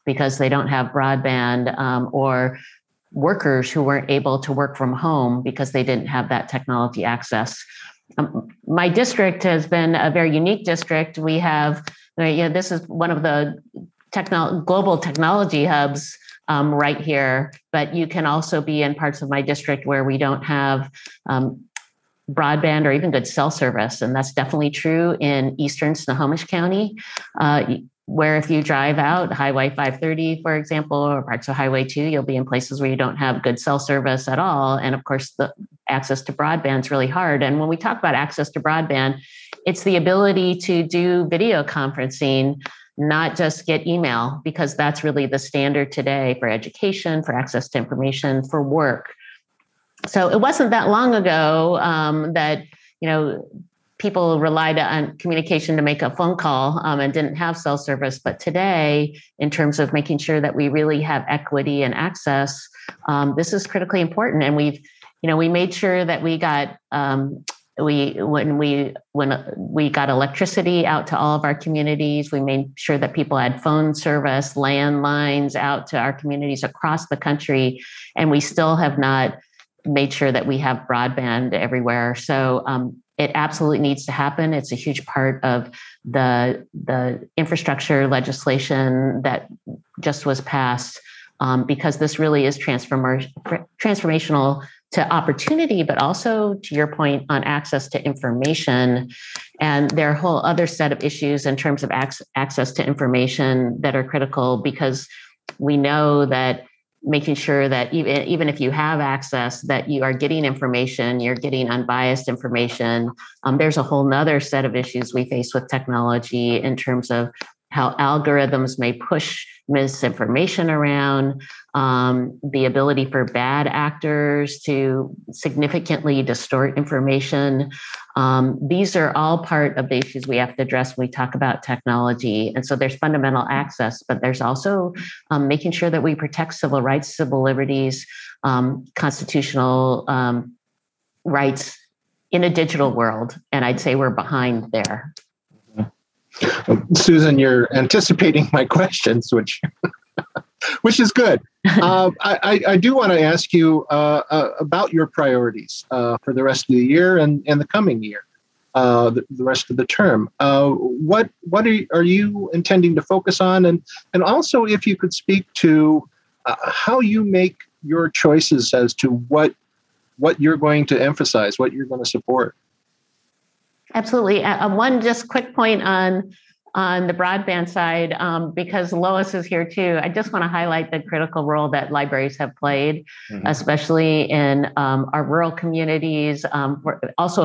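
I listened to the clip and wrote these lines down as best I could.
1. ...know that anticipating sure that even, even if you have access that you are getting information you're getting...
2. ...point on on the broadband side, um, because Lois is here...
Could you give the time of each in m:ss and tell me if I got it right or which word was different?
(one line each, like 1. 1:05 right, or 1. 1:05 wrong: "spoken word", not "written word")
1. 1:45 wrong: "making", not "anticipating"
2. 2:55 right.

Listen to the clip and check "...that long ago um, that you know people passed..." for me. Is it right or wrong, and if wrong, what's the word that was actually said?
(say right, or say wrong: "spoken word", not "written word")
wrong: "relied", not "passed".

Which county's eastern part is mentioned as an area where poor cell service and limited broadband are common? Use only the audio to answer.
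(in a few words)
Snohomish County.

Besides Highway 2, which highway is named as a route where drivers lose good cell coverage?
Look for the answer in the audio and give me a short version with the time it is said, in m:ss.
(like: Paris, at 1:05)
Highway 530, at 0:29.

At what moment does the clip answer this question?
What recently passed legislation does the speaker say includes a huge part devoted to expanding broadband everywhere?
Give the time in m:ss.
1:27.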